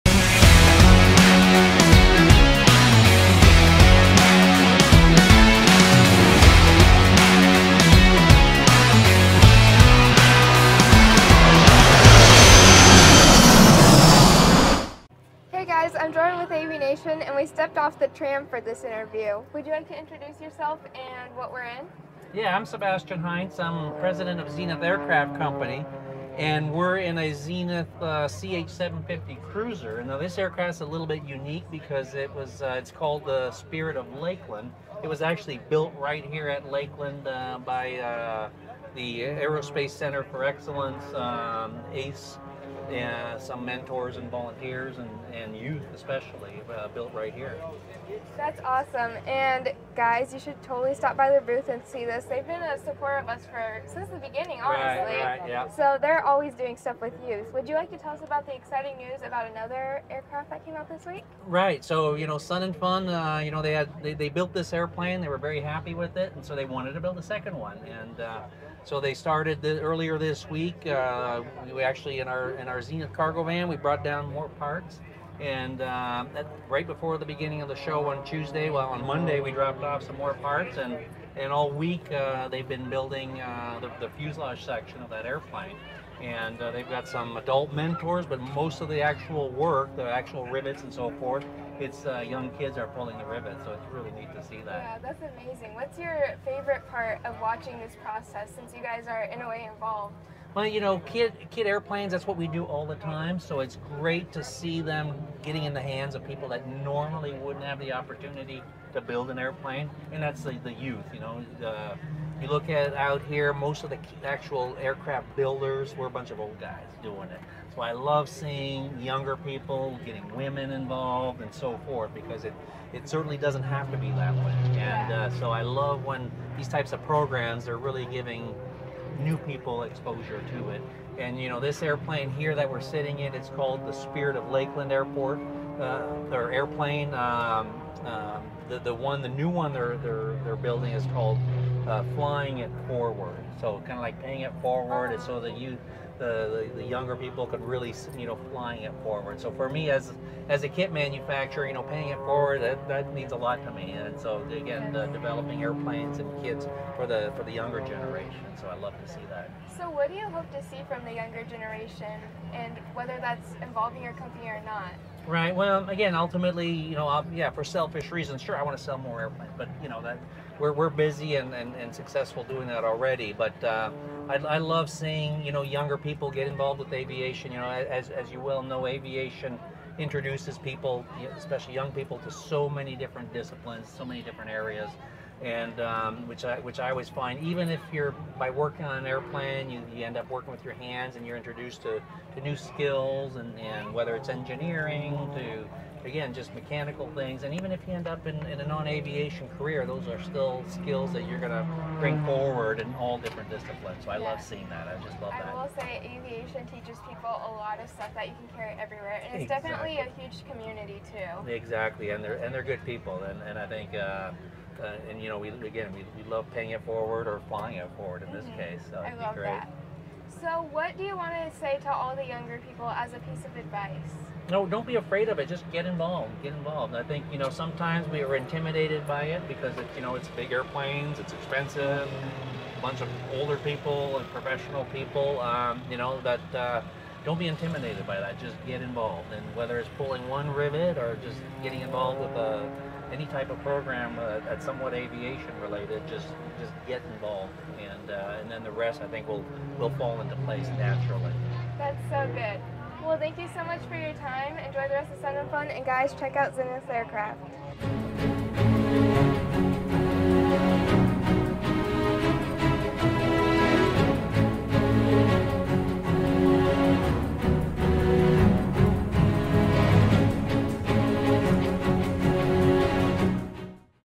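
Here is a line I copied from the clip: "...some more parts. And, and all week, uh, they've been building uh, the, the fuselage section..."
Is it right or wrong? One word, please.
right.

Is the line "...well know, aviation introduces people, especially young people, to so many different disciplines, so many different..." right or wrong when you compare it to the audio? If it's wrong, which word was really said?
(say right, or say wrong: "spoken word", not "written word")
right.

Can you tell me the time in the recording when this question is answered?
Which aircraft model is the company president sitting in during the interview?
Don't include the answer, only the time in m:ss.
0:28.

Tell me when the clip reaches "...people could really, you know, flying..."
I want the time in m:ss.
2:27.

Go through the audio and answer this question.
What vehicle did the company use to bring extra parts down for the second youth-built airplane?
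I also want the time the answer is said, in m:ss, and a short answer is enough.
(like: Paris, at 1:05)
Zenith cargo van, at 1:12.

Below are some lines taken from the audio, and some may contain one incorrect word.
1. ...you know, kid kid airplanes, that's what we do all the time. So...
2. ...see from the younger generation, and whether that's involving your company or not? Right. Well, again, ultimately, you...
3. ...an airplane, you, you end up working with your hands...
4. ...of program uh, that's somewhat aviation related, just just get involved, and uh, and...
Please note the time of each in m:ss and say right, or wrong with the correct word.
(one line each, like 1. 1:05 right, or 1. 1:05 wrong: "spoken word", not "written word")
1. 1:40 right
2. 2:40 right
3. 3:08 right
4. 4:03 right.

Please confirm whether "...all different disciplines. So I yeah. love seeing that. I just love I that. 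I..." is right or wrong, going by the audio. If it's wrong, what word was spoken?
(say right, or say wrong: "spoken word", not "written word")
right.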